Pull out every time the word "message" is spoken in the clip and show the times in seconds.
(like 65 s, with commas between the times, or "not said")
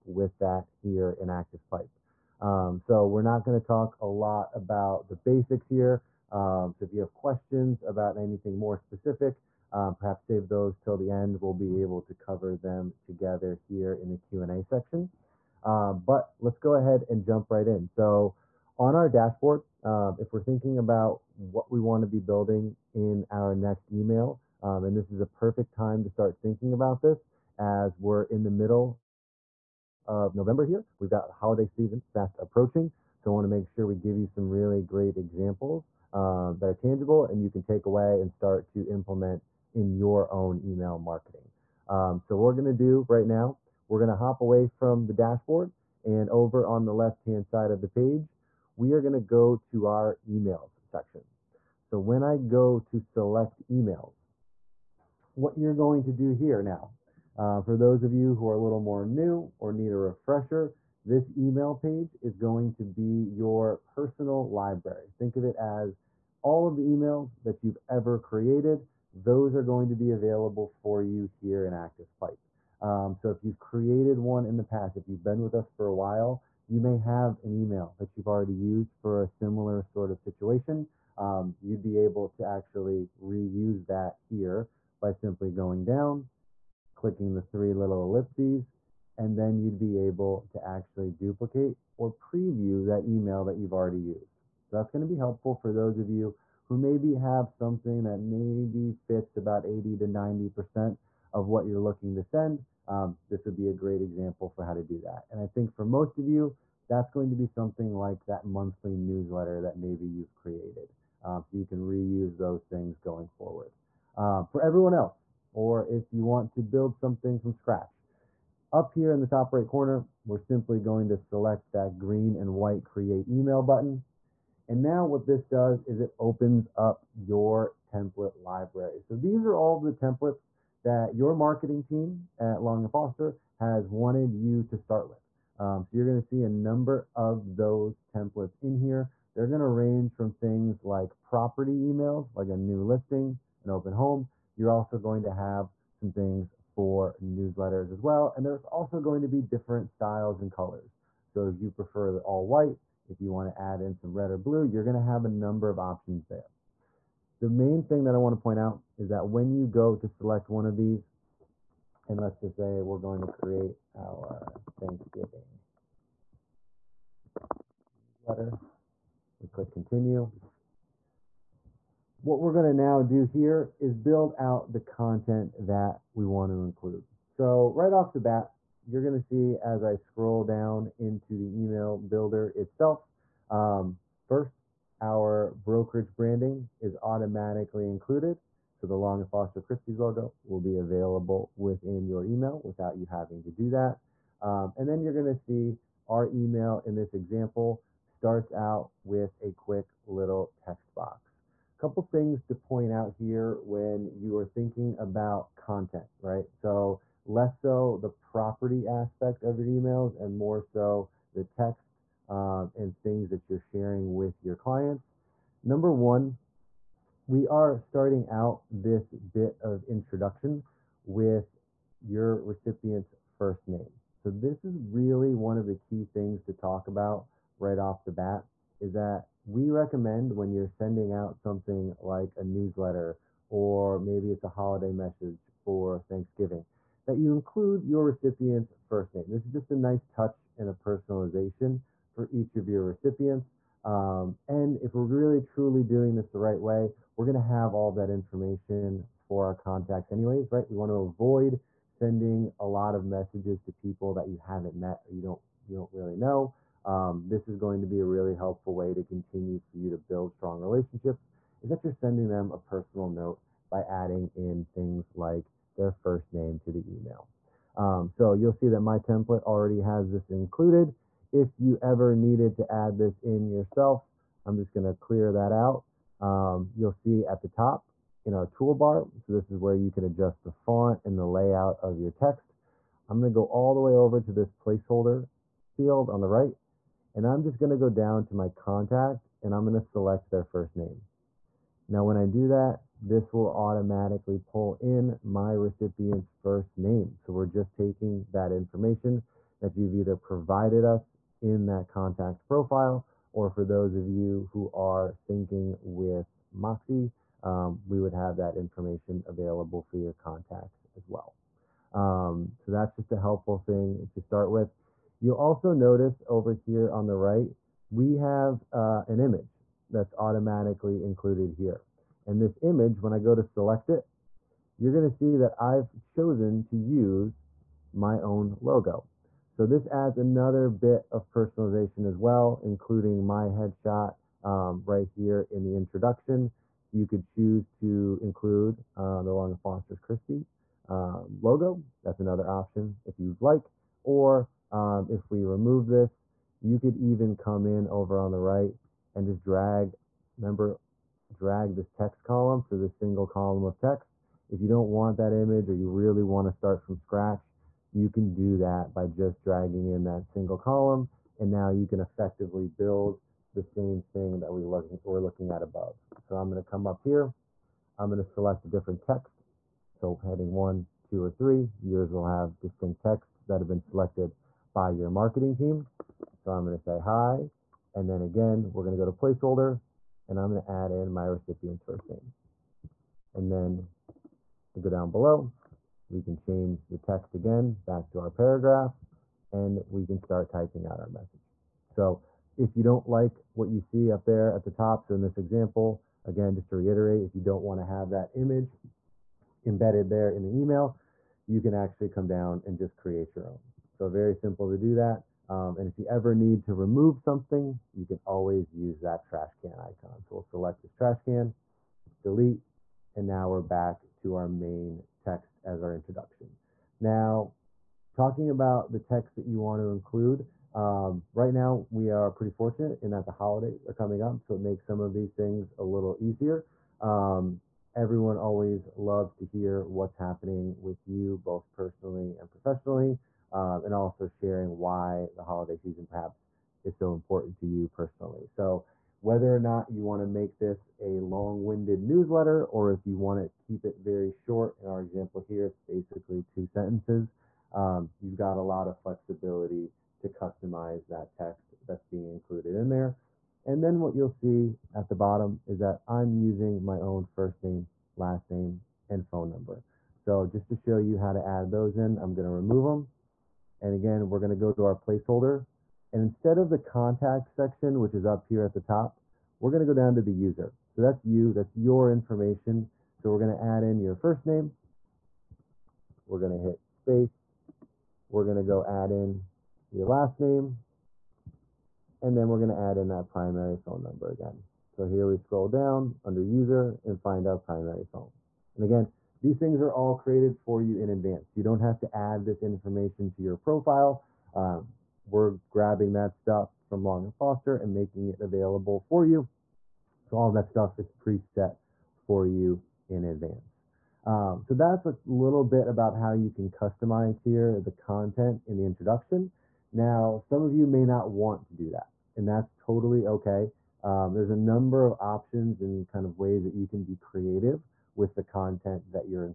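234 s, 253 s, 391 s.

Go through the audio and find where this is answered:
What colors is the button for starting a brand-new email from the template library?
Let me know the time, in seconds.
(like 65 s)
121 s.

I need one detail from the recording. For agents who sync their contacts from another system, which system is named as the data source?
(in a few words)
Moxi.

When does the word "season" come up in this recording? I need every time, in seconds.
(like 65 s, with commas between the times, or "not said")
31 s, 435 s.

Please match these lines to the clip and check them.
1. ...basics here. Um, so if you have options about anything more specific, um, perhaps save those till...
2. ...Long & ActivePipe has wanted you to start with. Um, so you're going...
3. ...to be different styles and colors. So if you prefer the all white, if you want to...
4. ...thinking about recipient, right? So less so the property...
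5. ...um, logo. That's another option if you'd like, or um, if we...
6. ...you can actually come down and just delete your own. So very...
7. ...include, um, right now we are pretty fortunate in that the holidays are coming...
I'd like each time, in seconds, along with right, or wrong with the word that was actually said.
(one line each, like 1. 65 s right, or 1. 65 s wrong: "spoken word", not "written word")
1. 5 s wrong: "questions", not "options"
2. 132 s wrong: "Foster", not "ActivePipe"
3. 149 s right
4. 204 s wrong: "content", not "recipient"
5. 340 s right
6. 401 s wrong: "create", not "delete"
7. 419 s right.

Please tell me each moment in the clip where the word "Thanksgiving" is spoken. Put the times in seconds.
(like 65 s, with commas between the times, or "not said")
164 s, 236 s.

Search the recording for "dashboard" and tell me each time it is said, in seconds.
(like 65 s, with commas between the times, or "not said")
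19 s, 45 s.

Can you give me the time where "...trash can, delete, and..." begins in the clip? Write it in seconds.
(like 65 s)
410 s.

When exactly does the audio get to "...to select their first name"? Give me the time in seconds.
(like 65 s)
289 s.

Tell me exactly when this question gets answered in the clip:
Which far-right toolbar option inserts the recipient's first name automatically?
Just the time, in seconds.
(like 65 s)
284 s.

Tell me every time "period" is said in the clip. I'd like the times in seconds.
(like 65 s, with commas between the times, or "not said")
not said.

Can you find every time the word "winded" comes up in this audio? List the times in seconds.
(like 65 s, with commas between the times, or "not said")
441 s.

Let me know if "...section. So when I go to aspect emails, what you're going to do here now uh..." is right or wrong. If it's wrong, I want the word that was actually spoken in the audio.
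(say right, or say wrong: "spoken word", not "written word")
wrong: "select", not "aspect".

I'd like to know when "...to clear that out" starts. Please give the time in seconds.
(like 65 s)
274 s.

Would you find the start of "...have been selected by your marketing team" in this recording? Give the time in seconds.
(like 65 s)
373 s.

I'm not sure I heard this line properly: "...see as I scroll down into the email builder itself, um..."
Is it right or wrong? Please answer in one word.
right.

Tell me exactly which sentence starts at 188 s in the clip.
So the Long and Foster Christie's logo will be available within your email without you having to do that.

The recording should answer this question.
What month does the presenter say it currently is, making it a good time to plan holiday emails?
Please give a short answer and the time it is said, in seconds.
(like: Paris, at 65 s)
November, at 30 s.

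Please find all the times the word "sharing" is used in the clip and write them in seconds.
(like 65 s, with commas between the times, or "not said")
213 s, 434 s.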